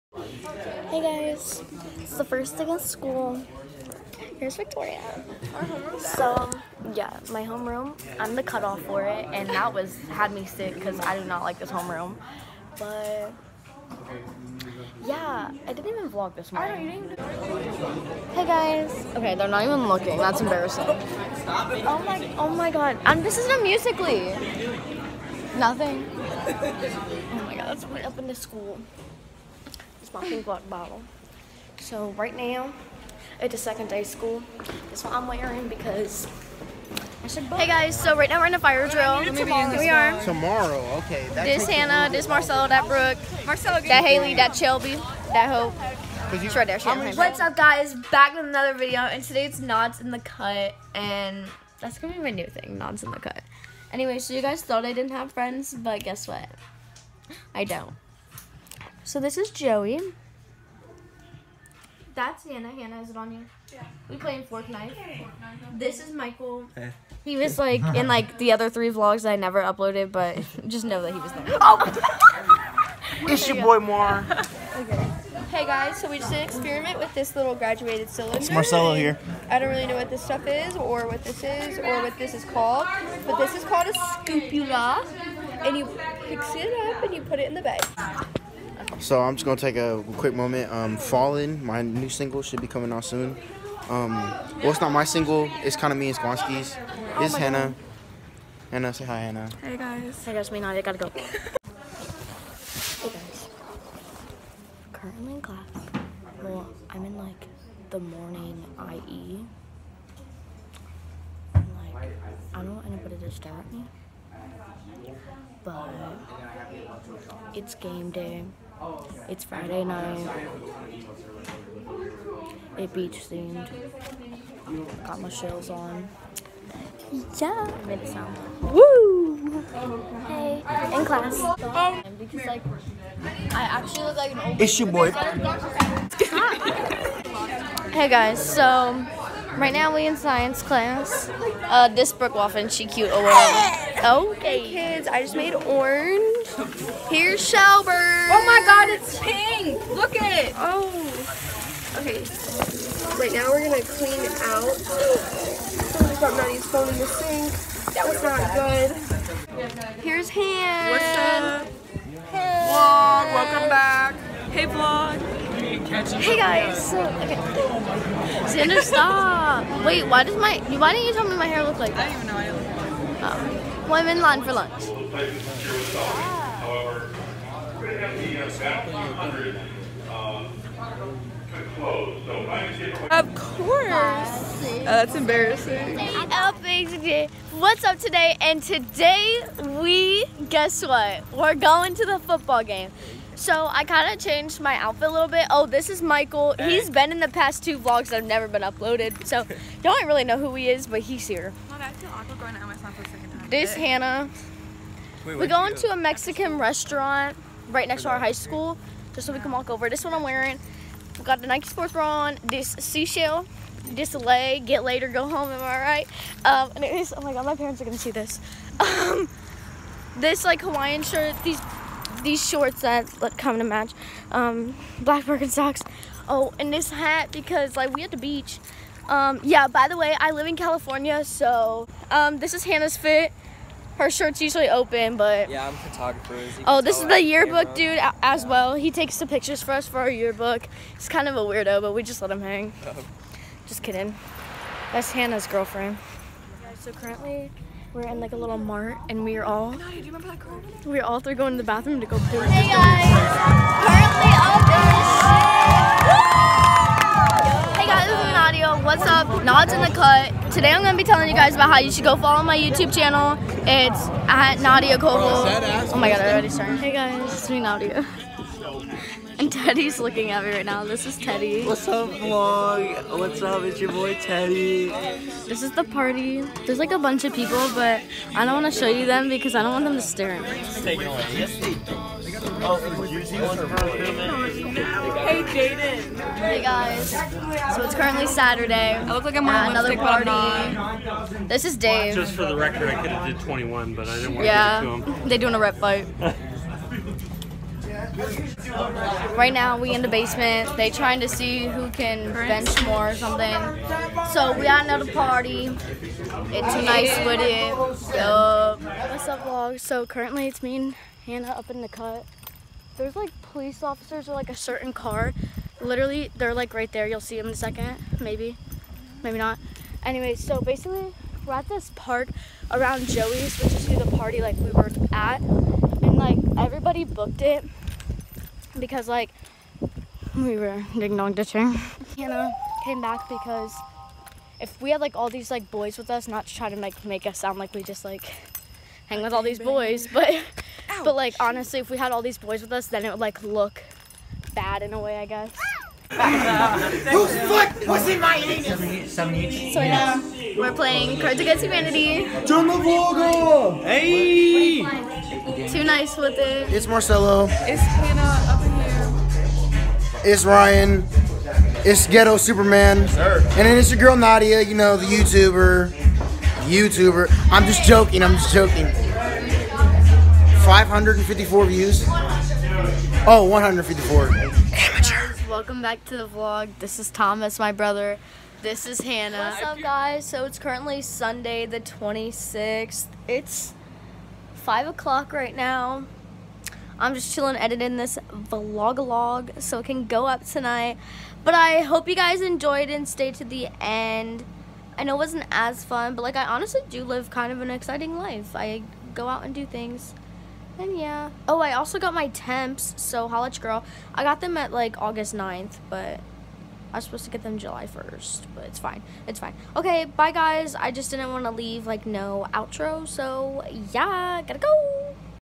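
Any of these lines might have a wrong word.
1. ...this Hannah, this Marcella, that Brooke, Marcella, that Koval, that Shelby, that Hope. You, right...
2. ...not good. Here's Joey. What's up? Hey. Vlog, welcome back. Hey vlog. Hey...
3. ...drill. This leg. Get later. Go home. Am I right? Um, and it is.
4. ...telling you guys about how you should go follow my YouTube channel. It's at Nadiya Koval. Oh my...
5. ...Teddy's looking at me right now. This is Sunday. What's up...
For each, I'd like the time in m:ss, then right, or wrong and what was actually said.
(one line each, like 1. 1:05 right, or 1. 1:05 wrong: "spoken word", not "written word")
1. 0:41 wrong: "Haley", not "Koval"
2. 2:38 wrong: "Han", not "Joey"
3. 3:32 wrong: "seashell", not "drill"
4. 4:21 right
5. 4:29 wrong: "Teddy", not "Sunday".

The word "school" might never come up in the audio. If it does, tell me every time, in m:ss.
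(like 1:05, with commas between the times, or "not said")
0:02, 0:28, 0:34, 3:28.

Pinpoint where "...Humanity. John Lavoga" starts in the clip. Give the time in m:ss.
5:51.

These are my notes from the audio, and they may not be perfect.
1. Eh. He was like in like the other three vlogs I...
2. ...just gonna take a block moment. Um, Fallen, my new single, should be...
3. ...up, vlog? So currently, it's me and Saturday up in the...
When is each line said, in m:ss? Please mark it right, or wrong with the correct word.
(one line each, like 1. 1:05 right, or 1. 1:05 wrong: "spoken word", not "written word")
1. 1:06 right
2. 1:29 wrong: "quick", not "block"
3. 5:08 wrong: "Hannah", not "Saturday".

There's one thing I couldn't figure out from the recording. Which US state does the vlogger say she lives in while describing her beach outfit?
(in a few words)
California.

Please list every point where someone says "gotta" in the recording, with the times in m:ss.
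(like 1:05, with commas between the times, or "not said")
1:40, 6:54.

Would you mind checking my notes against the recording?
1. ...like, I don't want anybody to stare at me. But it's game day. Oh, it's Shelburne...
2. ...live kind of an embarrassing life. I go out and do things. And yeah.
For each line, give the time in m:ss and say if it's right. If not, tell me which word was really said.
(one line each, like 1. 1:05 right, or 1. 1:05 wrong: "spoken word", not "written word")
1. 1:51 wrong: "Friday", not "Shelburne"
2. 6:37 wrong: "exciting", not "embarrassing".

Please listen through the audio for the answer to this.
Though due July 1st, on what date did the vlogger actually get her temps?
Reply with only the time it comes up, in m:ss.
6:45.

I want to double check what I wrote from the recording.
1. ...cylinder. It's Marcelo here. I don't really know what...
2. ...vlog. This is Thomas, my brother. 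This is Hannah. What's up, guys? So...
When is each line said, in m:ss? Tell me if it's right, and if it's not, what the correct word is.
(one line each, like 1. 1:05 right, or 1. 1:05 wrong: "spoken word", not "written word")
1. 1:18 right
2. 6:16 right.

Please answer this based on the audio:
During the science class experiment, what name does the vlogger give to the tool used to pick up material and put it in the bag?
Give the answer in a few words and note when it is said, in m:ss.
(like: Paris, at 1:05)
scoopula, at 1:23.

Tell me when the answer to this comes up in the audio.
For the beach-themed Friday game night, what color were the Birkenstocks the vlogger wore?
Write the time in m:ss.
3:44.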